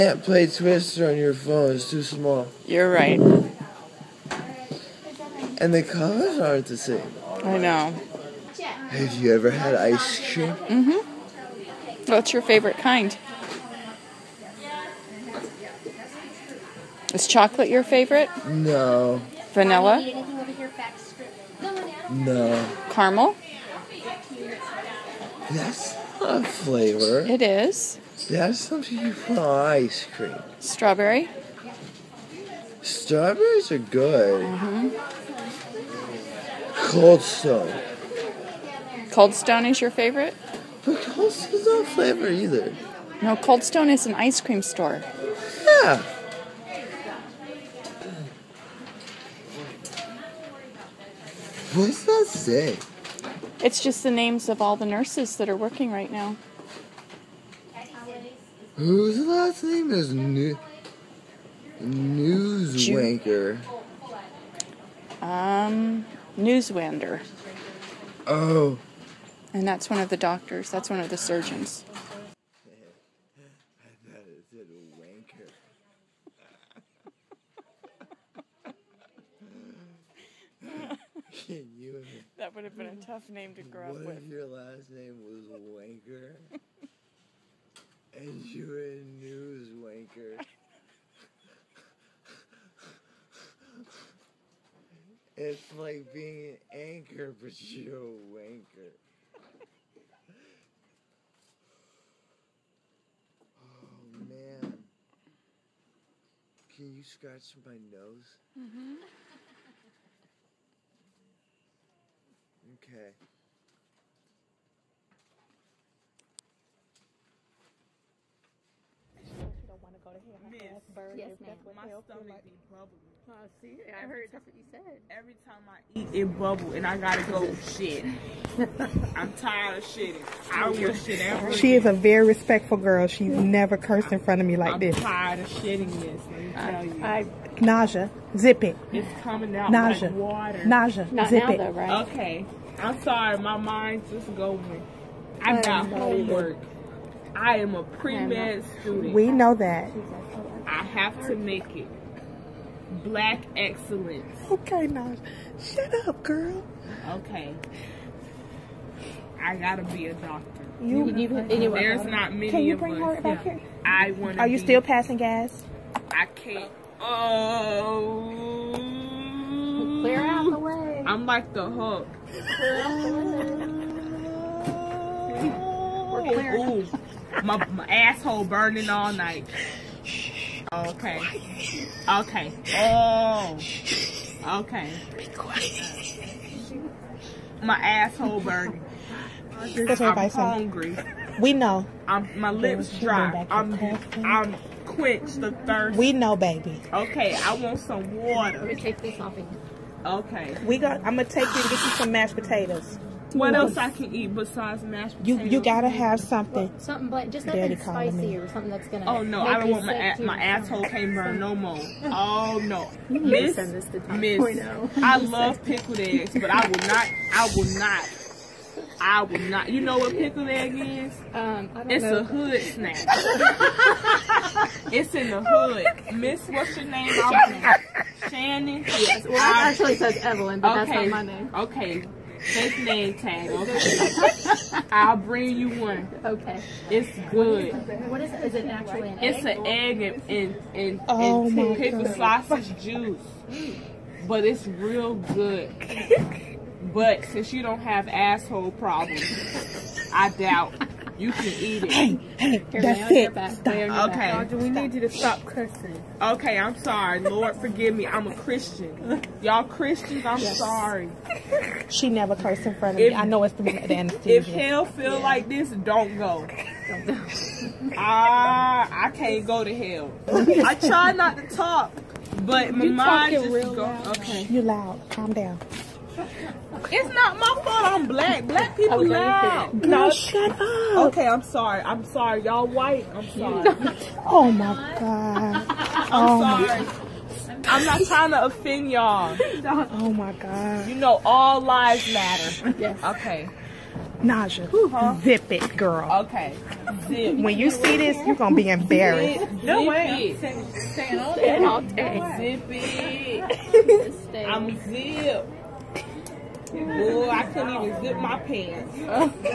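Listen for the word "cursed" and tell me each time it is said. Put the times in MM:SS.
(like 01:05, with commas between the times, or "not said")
02:13, 04:22.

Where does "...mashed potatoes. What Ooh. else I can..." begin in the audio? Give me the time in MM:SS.
03:22.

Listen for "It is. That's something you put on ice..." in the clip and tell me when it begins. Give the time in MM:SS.
00:27.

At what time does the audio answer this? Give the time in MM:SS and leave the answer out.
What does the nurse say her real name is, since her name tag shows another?
03:48.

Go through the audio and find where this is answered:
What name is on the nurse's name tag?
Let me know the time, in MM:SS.
03:50.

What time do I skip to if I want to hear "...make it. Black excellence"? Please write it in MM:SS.
02:31.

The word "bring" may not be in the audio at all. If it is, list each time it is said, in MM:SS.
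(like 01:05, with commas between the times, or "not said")
02:42, 03:55.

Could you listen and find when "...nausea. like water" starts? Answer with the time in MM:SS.
02:19.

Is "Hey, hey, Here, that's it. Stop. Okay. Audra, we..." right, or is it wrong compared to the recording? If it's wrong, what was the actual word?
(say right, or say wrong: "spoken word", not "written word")
right.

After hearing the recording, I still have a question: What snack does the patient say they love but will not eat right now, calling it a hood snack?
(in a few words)
pickled eggs.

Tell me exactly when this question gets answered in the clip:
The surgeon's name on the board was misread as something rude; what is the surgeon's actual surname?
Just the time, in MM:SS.
01:06.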